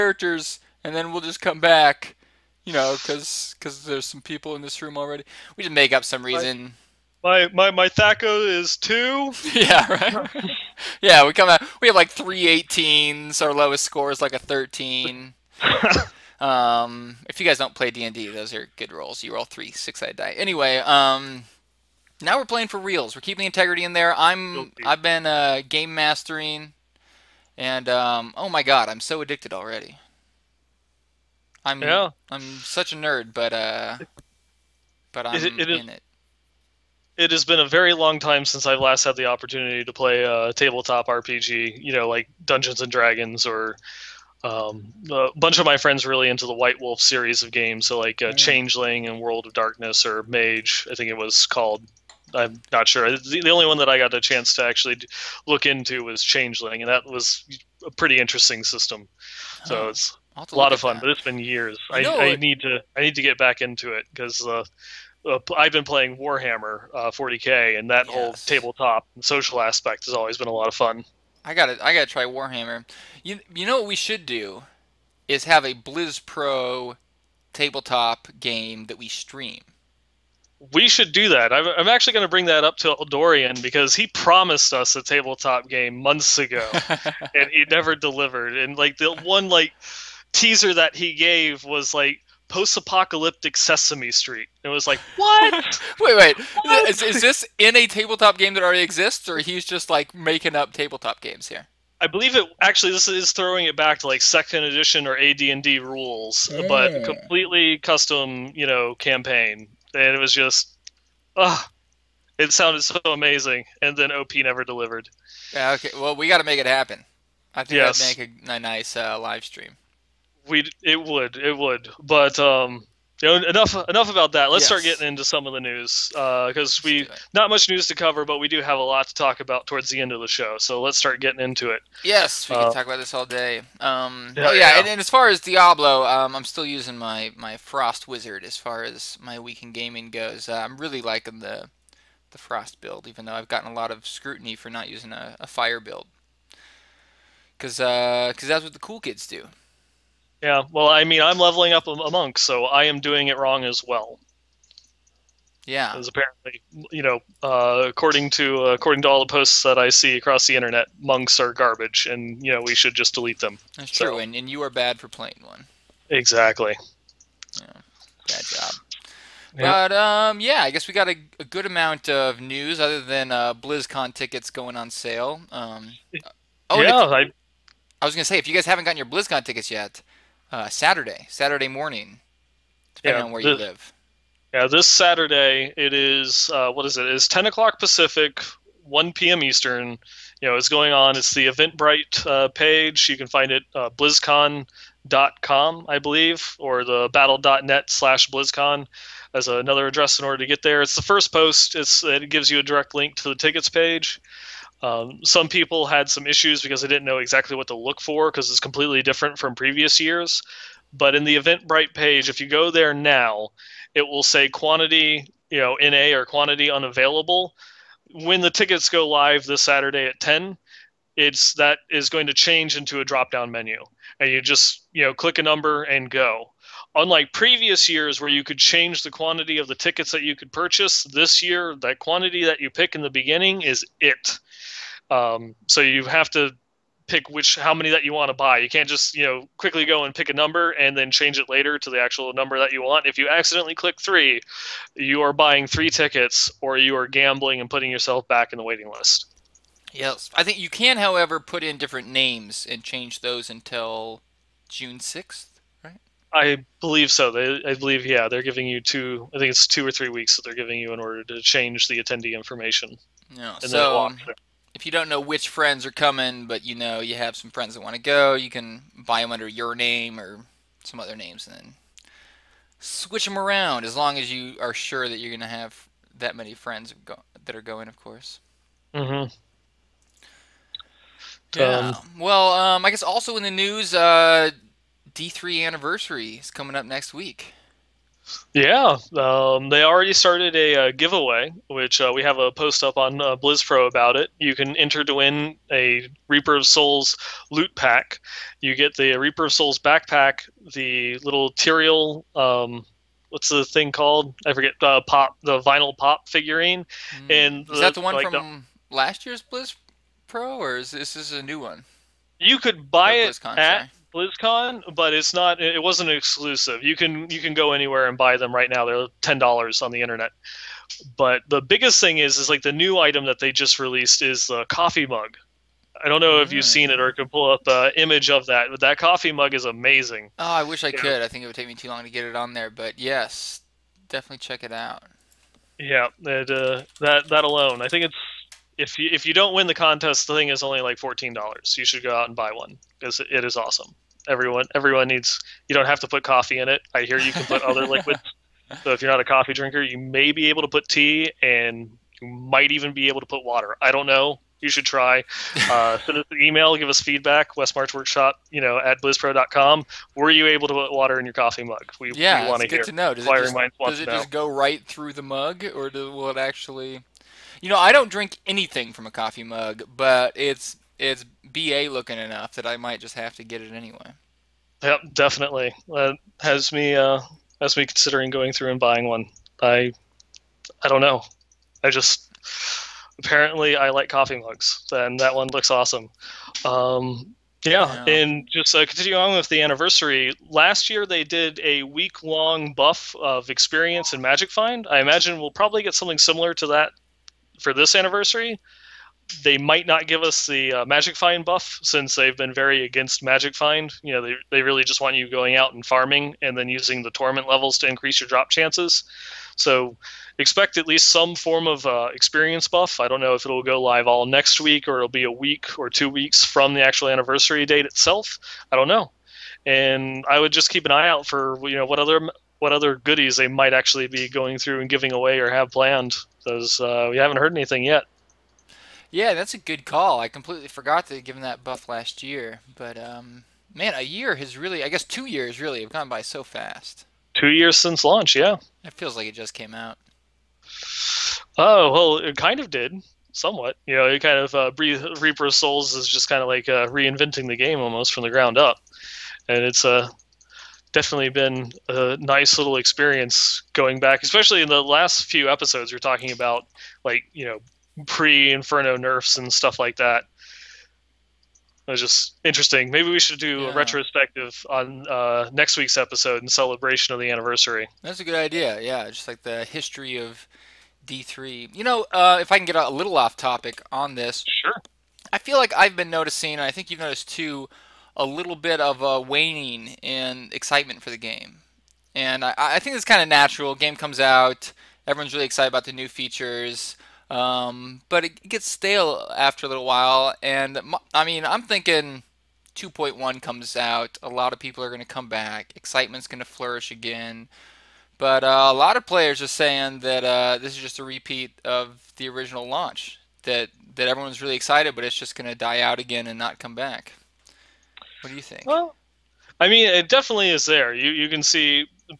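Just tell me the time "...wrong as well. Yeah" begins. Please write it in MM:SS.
02:33.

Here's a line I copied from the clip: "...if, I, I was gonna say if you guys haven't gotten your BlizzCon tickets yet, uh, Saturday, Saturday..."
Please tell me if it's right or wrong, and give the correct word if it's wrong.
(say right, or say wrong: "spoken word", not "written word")
right.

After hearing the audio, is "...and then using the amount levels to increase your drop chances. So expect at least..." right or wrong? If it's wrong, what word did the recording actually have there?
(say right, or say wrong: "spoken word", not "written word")
wrong: "torment", not "amount".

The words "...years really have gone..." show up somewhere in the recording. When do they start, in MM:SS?
07:15.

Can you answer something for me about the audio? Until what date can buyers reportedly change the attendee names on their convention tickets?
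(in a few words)
June 6.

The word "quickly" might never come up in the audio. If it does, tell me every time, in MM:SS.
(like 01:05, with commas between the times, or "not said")
03:59.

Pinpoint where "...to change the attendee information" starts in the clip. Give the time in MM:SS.
04:21.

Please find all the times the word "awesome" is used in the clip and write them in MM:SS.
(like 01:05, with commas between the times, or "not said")
05:43, 06:25.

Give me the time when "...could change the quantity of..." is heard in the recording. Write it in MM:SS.
03:48.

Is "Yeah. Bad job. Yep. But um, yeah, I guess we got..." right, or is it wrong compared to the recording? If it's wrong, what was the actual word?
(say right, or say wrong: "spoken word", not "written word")
right.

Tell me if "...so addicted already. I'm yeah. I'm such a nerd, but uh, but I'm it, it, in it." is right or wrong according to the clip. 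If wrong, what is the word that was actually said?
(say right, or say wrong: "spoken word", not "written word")
right.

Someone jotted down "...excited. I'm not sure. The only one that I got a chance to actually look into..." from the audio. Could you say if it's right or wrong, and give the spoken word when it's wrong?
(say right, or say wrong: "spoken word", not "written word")
wrong: "called", not "excited".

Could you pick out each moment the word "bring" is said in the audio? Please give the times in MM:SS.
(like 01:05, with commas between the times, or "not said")
01:22.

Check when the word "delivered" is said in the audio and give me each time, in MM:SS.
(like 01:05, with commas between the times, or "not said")
01:27, 01:54.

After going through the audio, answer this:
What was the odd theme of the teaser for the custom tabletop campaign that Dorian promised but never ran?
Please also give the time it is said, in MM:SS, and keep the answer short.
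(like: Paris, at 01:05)
post-apocalyptic Sesame Street, at 01:32.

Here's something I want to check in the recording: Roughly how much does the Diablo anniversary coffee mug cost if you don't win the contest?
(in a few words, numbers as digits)
$14.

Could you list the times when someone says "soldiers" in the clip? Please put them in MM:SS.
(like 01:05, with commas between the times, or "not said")
not said.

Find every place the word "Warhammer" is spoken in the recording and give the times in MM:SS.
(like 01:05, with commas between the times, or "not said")
01:06, 01:12.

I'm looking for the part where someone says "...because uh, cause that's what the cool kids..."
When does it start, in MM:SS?
02:27.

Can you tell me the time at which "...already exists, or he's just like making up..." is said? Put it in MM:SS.
01:38.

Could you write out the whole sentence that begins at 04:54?
You can enter to win a Reaper of Souls loot pack.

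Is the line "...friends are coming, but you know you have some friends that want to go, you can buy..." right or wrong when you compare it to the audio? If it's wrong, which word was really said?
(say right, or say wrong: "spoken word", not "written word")
right.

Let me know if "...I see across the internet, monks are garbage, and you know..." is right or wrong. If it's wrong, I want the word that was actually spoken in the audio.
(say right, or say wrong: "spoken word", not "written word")
right.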